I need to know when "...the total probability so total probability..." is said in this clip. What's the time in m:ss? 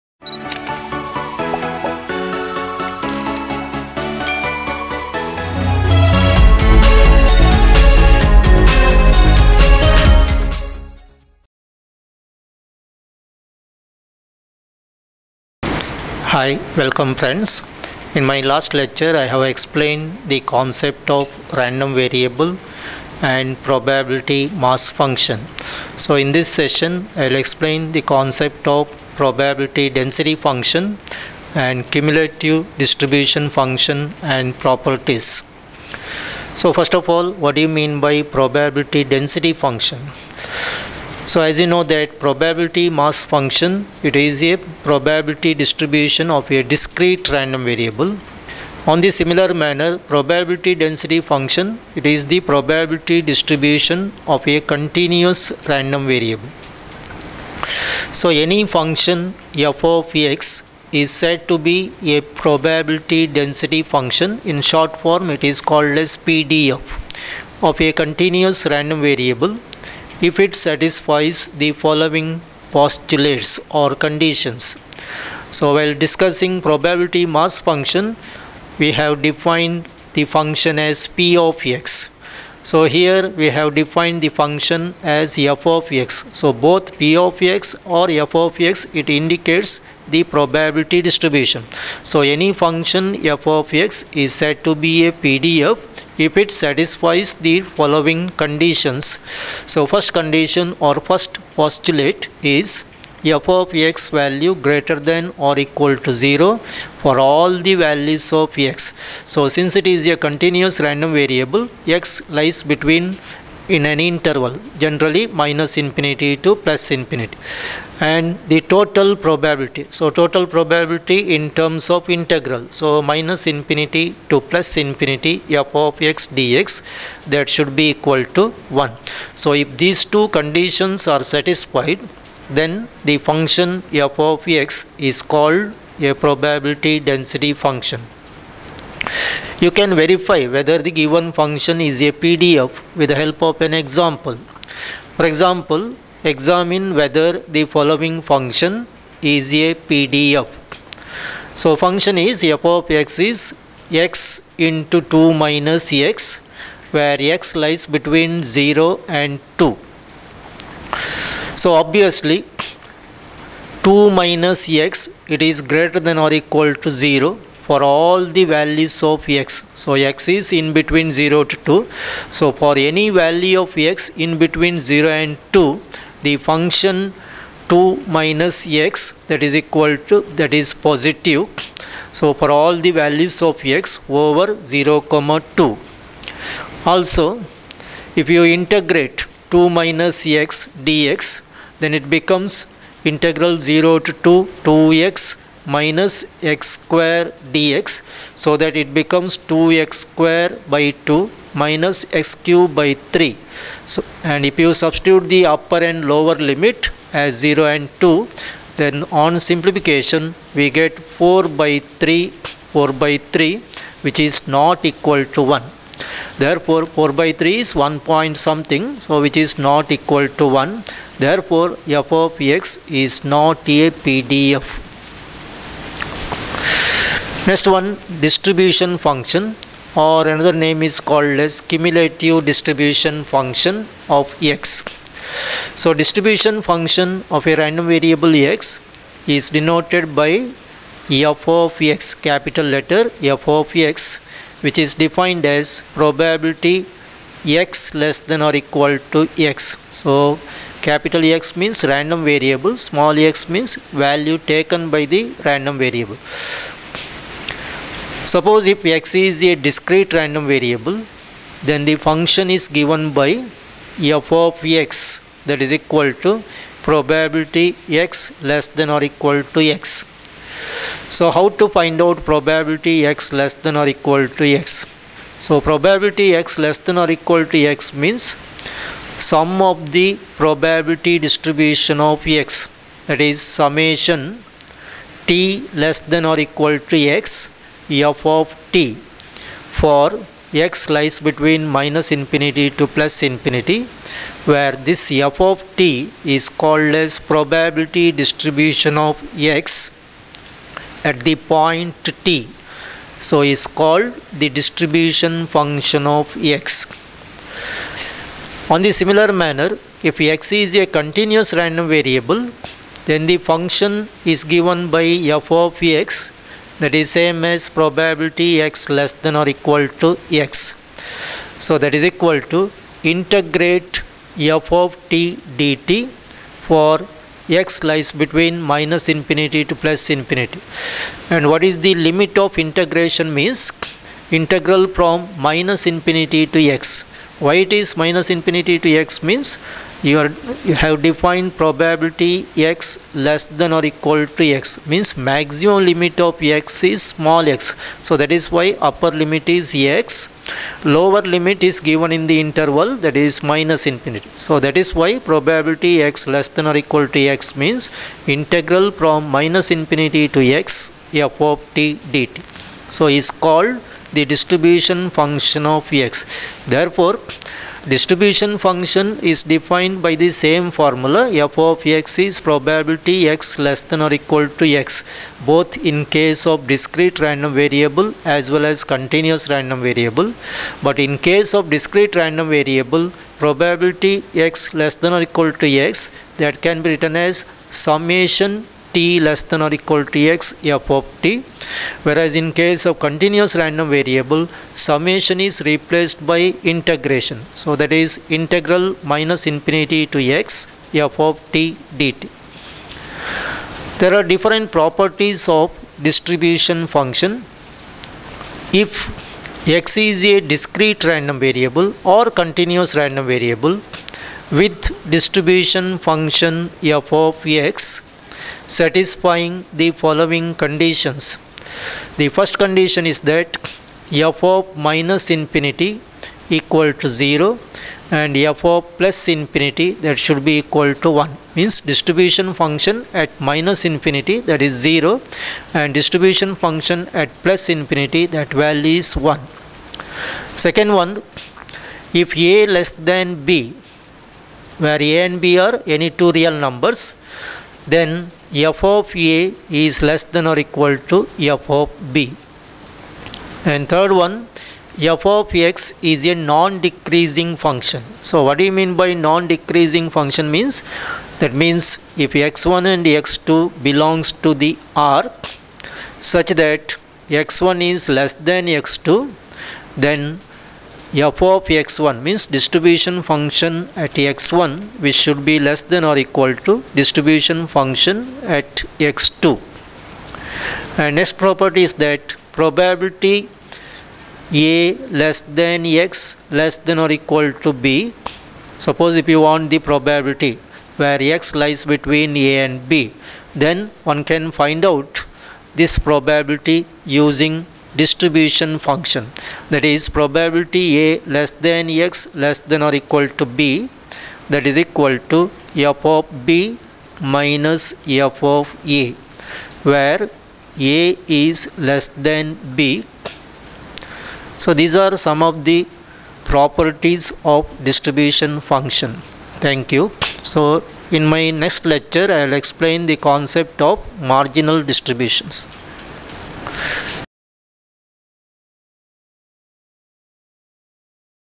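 1:58.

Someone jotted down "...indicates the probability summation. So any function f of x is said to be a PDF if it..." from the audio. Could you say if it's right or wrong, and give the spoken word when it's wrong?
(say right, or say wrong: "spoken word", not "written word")
wrong: "distribution", not "summation".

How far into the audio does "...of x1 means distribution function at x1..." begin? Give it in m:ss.
7:51.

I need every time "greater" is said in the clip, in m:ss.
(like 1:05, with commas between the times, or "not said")
1:44, 2:45.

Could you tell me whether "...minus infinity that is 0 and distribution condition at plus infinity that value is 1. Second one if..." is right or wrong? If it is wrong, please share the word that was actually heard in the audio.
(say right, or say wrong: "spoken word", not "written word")
wrong: "function", not "condition".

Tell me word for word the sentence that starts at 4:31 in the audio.
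So how to find out probability x less than or equal to x?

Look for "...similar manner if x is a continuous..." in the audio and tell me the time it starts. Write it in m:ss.
5:09.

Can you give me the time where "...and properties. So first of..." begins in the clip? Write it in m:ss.
0:34.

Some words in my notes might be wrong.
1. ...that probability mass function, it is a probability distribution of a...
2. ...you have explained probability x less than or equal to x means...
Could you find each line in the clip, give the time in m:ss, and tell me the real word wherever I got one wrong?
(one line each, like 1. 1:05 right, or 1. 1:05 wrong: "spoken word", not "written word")
1. 0:41 right
2. 5:40 wrong: "defined", not "explained".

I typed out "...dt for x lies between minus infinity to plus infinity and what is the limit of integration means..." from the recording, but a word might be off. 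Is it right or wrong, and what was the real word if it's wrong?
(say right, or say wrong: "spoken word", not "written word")
right.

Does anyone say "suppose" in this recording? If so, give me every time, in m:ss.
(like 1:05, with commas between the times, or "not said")
4:18, 8:08.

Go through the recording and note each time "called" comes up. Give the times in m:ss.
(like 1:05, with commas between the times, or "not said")
1:05, 2:15, 3:51, 4:56, 5:03, 6:03.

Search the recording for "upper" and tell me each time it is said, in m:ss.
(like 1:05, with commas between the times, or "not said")
3:25, 5:48.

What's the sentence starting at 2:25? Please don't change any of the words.
For example, examine whether the following function is a PDF.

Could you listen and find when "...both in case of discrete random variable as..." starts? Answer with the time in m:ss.
6:15.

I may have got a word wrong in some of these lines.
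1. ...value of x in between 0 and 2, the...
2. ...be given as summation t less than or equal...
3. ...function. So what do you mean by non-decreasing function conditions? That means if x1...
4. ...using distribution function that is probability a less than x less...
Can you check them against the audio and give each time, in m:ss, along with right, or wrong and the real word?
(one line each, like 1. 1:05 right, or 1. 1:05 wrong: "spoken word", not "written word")
1. 2:53 right
2. 6:26 wrong: "written", not "given"
3. 7:37 wrong: "means", not "conditions"
4. 8:17 right.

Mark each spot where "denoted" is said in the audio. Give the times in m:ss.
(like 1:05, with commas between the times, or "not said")
3:59.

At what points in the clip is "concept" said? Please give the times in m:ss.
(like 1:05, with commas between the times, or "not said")
0:20, 0:28, 8:43.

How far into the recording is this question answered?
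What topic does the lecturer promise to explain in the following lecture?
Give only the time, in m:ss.
8:44.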